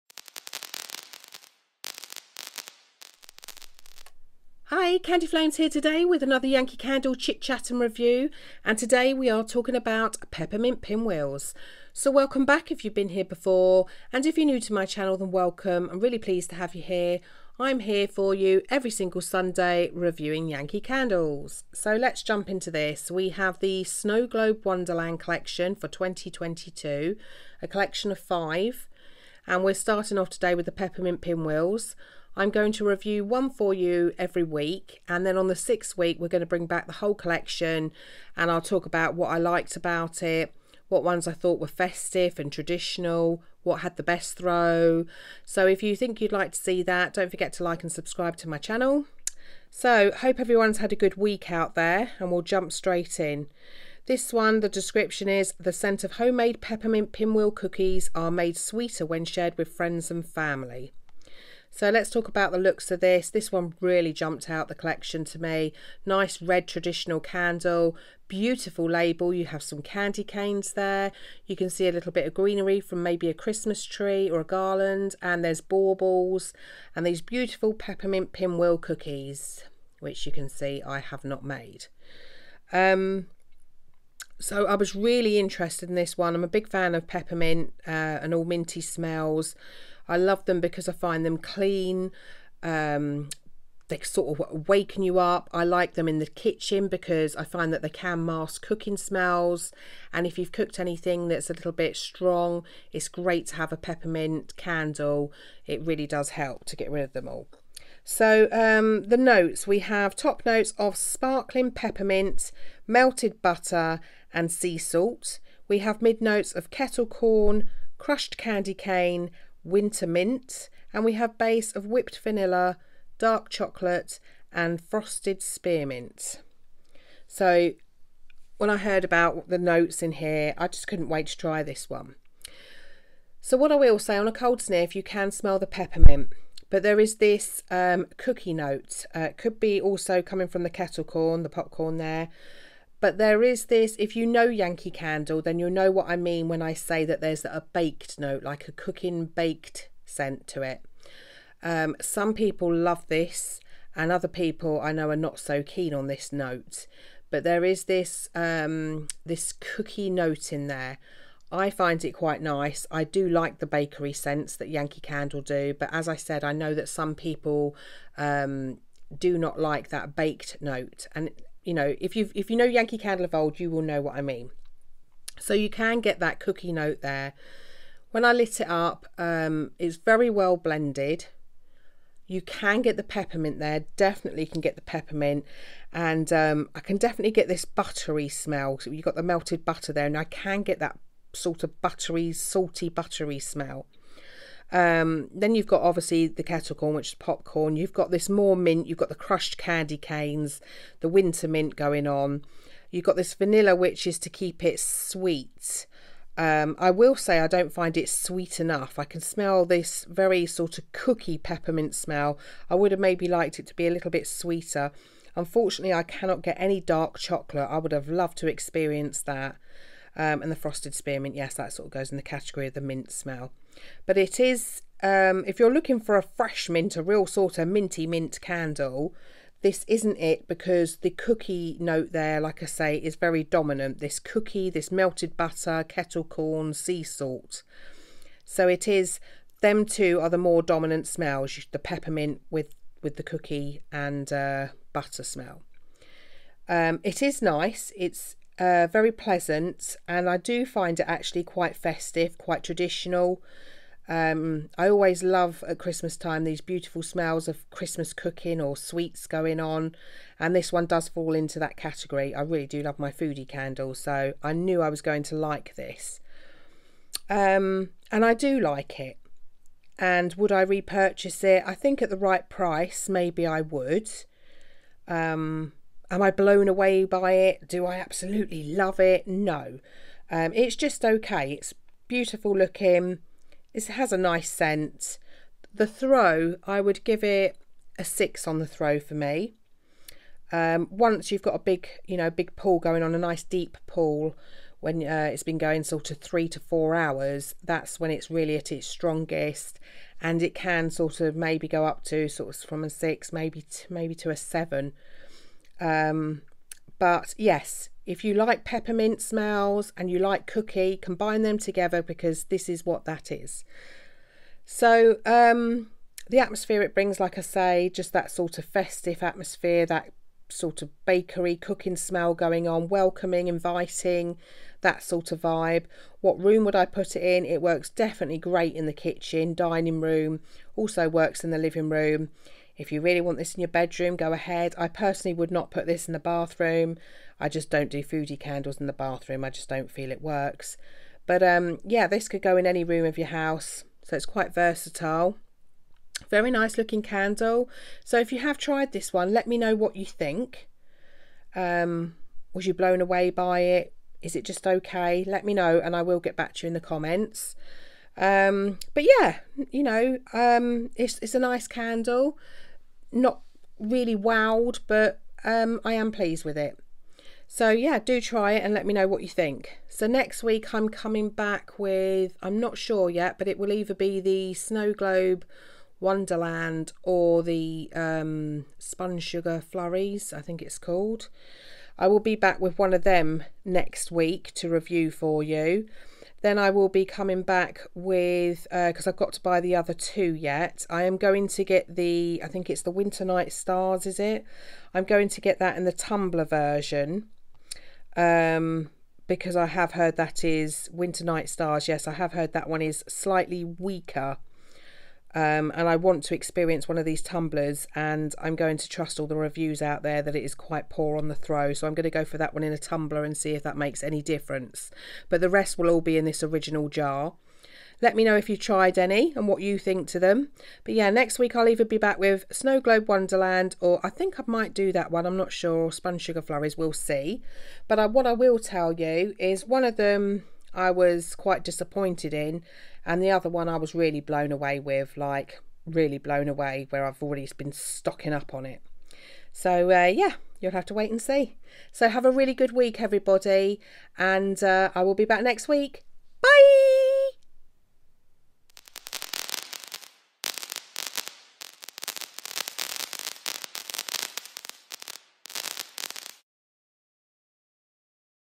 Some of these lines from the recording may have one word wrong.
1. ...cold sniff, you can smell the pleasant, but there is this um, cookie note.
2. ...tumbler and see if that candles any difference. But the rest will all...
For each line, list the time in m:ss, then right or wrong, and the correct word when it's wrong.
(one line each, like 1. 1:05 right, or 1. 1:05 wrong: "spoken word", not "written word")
1. 2:14 wrong: "peppermint", not "pleasant"
2. 6:52 wrong: "makes", not "candles".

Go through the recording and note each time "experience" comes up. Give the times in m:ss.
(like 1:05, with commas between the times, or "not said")
3:38, 6:46.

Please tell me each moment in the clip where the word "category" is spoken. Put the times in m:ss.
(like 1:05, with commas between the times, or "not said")
3:42, 4:21.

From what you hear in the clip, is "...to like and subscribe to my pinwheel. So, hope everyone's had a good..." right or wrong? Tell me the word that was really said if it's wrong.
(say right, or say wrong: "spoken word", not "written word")
wrong: "channel", not "pinwheel".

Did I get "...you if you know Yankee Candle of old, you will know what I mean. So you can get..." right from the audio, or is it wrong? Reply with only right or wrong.
right.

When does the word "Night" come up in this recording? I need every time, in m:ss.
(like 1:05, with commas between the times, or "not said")
6:33, 6:41.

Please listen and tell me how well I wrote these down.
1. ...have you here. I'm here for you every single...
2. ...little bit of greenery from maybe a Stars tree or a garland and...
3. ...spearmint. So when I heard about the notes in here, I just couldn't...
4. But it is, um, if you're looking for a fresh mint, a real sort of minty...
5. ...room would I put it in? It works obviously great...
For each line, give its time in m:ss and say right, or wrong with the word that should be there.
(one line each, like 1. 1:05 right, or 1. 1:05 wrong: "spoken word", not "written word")
1. 0:16 right
2. 1:11 wrong: "Christmas", not "Stars"
3. 2:05 right
4. 3:44 right
5. 5:26 wrong: "definitely", not "obviously".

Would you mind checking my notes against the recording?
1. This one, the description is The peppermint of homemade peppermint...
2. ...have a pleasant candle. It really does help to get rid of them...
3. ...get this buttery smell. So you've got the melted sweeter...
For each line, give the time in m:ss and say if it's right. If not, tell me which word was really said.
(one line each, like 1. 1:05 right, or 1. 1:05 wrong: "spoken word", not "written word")
1. 0:54 wrong: "scent", not "peppermint"
2. 1:43 wrong: "peppermint", not "pleasant"
3. 3:07 wrong: "butter", not "sweeter".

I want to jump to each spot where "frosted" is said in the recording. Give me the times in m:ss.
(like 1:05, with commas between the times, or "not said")
2:04, 3:40.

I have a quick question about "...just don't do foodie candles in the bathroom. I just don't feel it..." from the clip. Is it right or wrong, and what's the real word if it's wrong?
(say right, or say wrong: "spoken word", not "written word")
right.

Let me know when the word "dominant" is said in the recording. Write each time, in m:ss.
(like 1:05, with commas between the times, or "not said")
3:53, 4:00.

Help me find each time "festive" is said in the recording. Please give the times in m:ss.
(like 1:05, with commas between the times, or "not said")
0:41, 4:11, 5:18.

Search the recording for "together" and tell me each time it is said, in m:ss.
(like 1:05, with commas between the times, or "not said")
5:11.